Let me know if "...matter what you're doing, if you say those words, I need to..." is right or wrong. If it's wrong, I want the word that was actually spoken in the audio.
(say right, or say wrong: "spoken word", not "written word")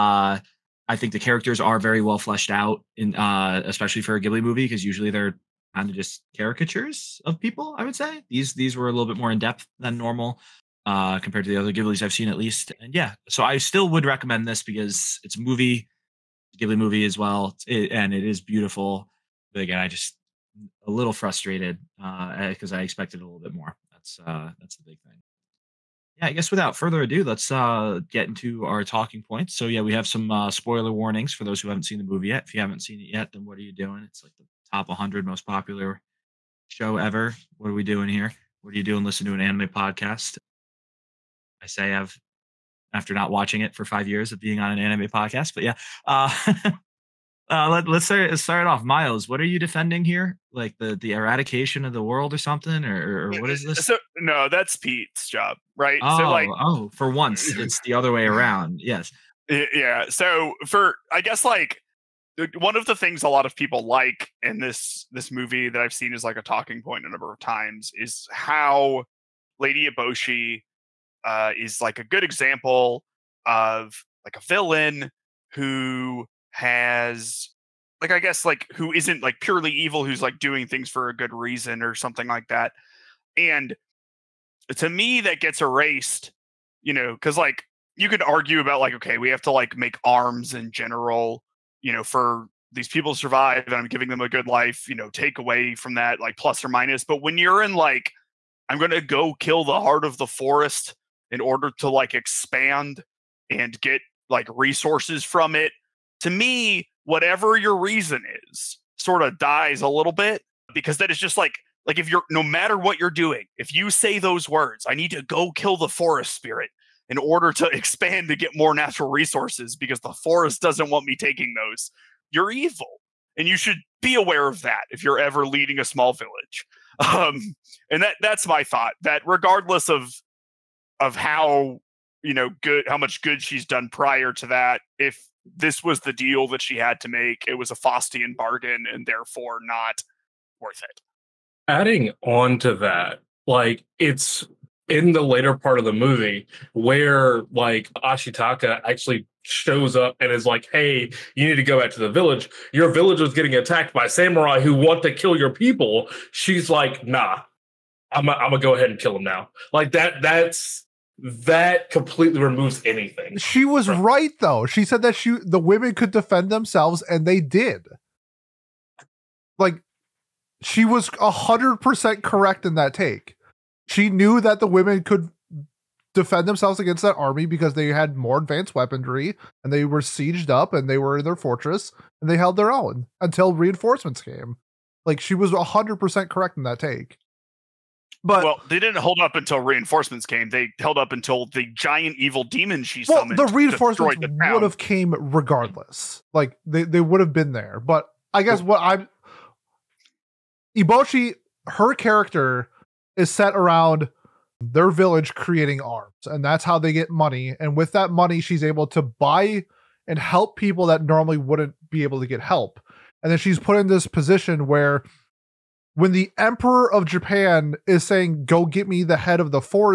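right.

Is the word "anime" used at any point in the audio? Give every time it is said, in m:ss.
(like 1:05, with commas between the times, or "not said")
0:39, 0:44.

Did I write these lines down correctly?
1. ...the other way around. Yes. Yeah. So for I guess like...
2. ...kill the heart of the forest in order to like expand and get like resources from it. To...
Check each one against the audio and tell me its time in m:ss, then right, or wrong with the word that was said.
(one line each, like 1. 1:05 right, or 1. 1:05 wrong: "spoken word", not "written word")
1. 0:57 right
2. 1:39 right.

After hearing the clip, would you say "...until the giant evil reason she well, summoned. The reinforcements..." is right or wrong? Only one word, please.
wrong.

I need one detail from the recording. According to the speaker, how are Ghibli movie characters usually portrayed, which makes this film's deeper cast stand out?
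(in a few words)
Caricatures.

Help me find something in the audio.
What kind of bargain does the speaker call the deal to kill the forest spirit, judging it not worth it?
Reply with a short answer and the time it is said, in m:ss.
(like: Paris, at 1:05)
Faustian bargain, at 2:17.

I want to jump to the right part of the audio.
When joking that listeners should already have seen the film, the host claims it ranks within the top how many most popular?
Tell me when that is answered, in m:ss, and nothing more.
0:34.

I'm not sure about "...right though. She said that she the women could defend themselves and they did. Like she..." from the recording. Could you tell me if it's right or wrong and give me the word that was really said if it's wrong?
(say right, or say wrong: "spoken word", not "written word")
right.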